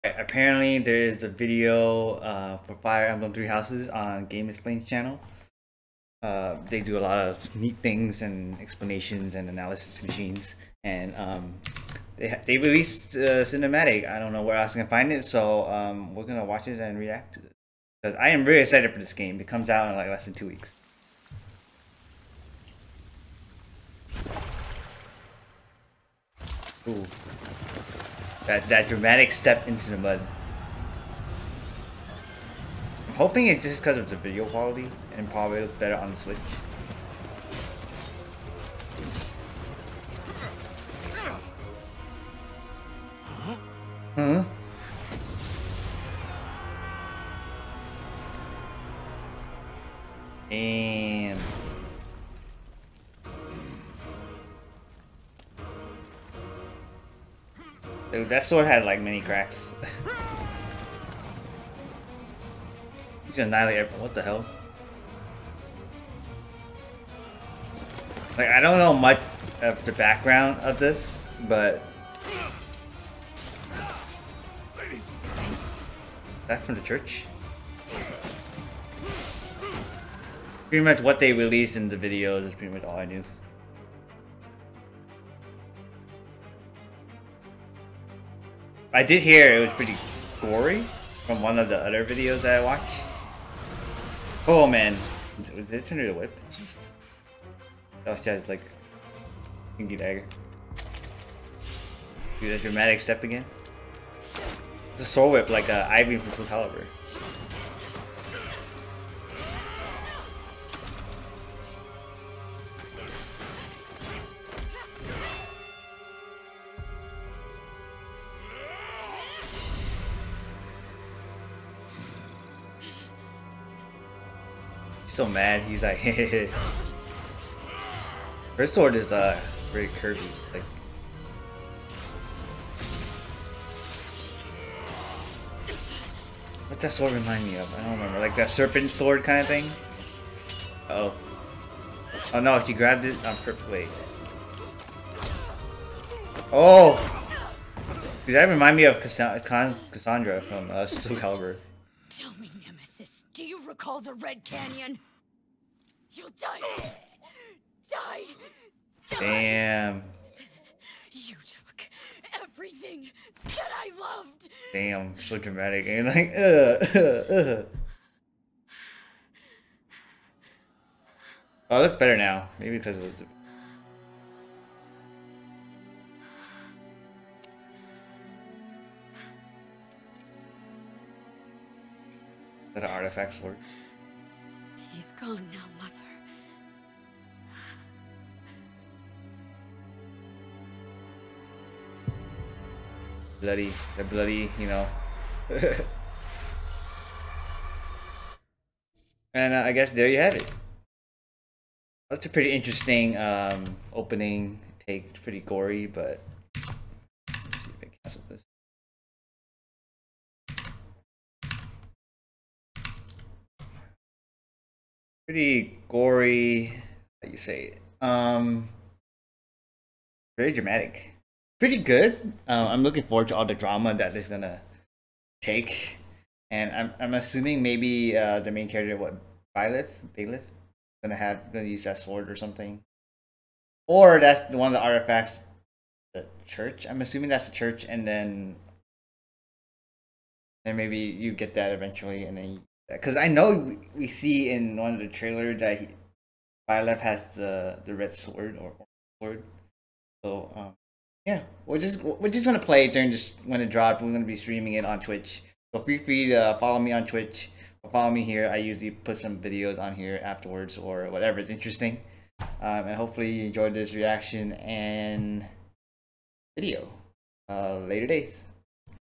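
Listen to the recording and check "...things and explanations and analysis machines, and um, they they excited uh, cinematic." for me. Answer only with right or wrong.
wrong.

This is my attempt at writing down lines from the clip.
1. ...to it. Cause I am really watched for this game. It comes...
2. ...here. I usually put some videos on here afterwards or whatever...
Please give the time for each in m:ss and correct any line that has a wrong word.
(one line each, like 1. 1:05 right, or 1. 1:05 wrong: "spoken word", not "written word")
1. 0:17 wrong: "excited", not "watched"
2. 4:18 right.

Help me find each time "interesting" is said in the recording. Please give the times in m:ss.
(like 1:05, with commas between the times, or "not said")
3:22, 4:21.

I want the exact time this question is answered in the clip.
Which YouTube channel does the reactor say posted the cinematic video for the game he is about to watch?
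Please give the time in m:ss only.
0:04.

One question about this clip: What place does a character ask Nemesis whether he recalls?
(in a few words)
the Red Canyon.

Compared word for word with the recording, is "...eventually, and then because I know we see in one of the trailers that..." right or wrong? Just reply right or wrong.
right.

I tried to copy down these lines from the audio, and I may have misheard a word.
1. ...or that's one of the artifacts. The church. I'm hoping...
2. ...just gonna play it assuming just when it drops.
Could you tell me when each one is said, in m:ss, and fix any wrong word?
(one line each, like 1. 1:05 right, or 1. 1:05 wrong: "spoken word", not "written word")
1. 3:53 wrong: "assuming", not "hoping"
2. 4:12 wrong: "during", not "assuming".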